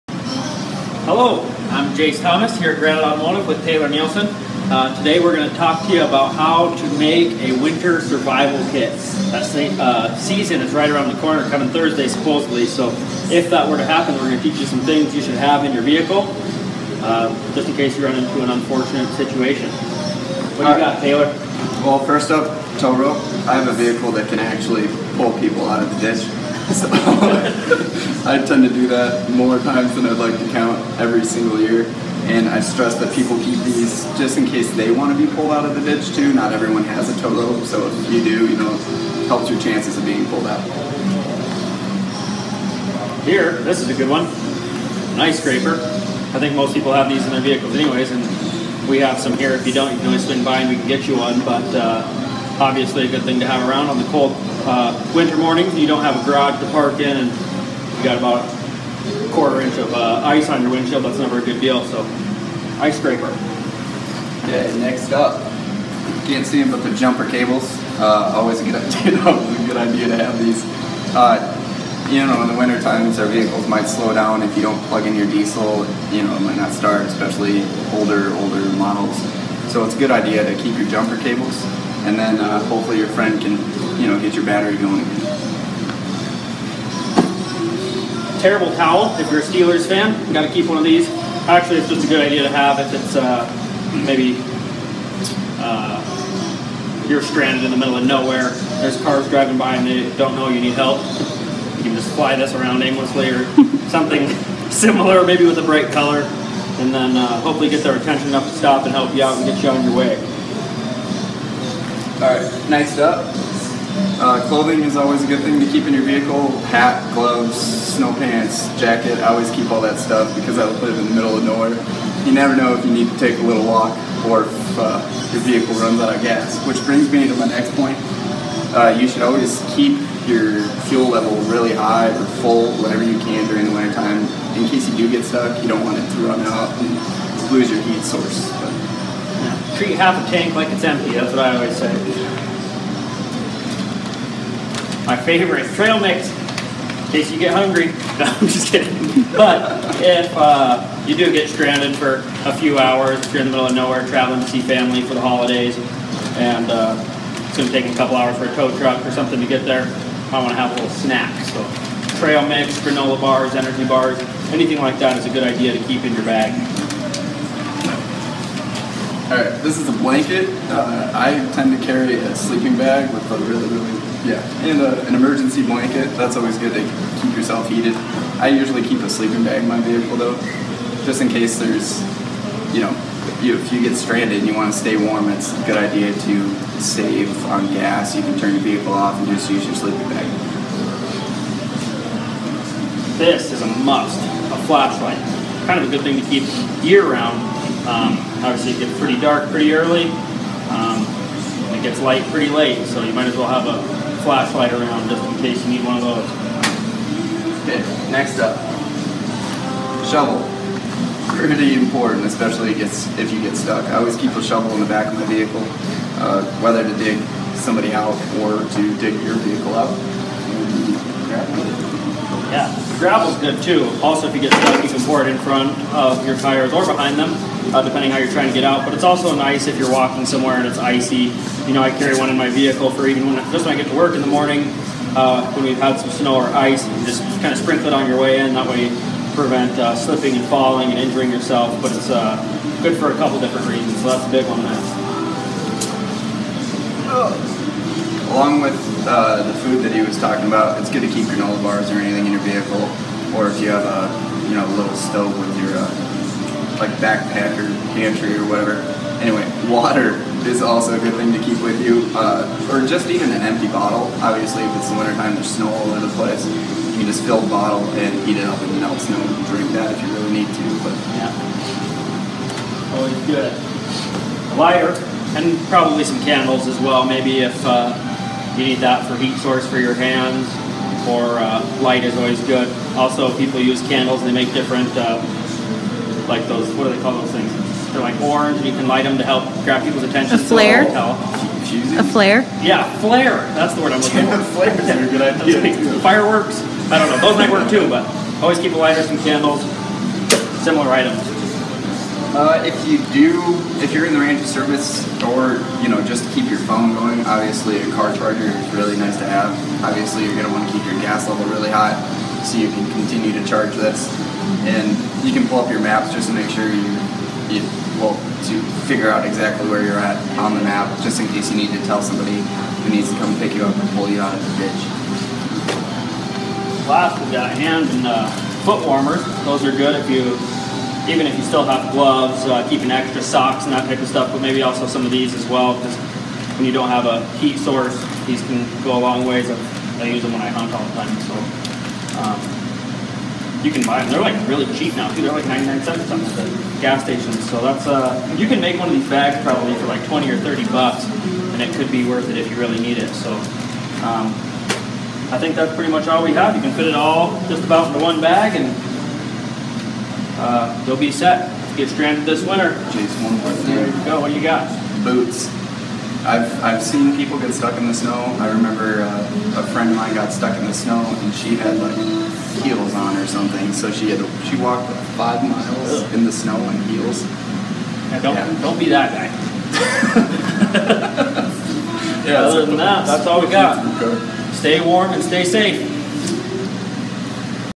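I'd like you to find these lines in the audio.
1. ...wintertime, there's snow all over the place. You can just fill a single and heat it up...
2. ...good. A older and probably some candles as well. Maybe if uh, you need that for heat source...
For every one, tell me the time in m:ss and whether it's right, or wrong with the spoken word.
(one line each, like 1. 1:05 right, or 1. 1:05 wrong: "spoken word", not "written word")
1. 4:24 wrong: "bottle", not "single"
2. 4:33 wrong: "lighter", not "older".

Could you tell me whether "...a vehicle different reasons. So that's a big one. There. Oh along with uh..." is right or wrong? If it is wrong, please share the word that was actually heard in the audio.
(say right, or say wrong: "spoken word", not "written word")
wrong: "couple", not "vehicle".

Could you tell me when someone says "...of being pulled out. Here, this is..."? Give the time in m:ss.
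0:39.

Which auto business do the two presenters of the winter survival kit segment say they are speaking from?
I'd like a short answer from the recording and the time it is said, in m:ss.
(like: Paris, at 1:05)
Granite Automotive, at 0:02.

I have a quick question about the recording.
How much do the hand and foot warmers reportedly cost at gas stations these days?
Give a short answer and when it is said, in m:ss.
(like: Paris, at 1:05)
99 cents, at 5:45.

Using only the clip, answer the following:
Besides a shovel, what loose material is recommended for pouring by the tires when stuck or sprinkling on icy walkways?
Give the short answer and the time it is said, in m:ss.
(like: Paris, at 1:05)
gravel, at 3:42.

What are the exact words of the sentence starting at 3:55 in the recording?
Uh, when we've had some snow or ice, you just kind of sprinkle it on your way in.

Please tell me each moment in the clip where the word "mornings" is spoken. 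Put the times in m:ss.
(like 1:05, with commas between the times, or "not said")
0:55, 3:54.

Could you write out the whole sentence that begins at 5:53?
So um, I think that's pretty much all we have.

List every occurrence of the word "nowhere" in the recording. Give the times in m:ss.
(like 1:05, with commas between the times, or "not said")
1:38, 2:01, 2:33.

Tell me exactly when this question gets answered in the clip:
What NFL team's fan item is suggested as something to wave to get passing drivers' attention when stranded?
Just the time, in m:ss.
1:29.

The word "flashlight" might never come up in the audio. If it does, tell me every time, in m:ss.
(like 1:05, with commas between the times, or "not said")
3:14, 3:24.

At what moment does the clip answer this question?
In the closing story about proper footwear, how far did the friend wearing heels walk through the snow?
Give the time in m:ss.
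6:15.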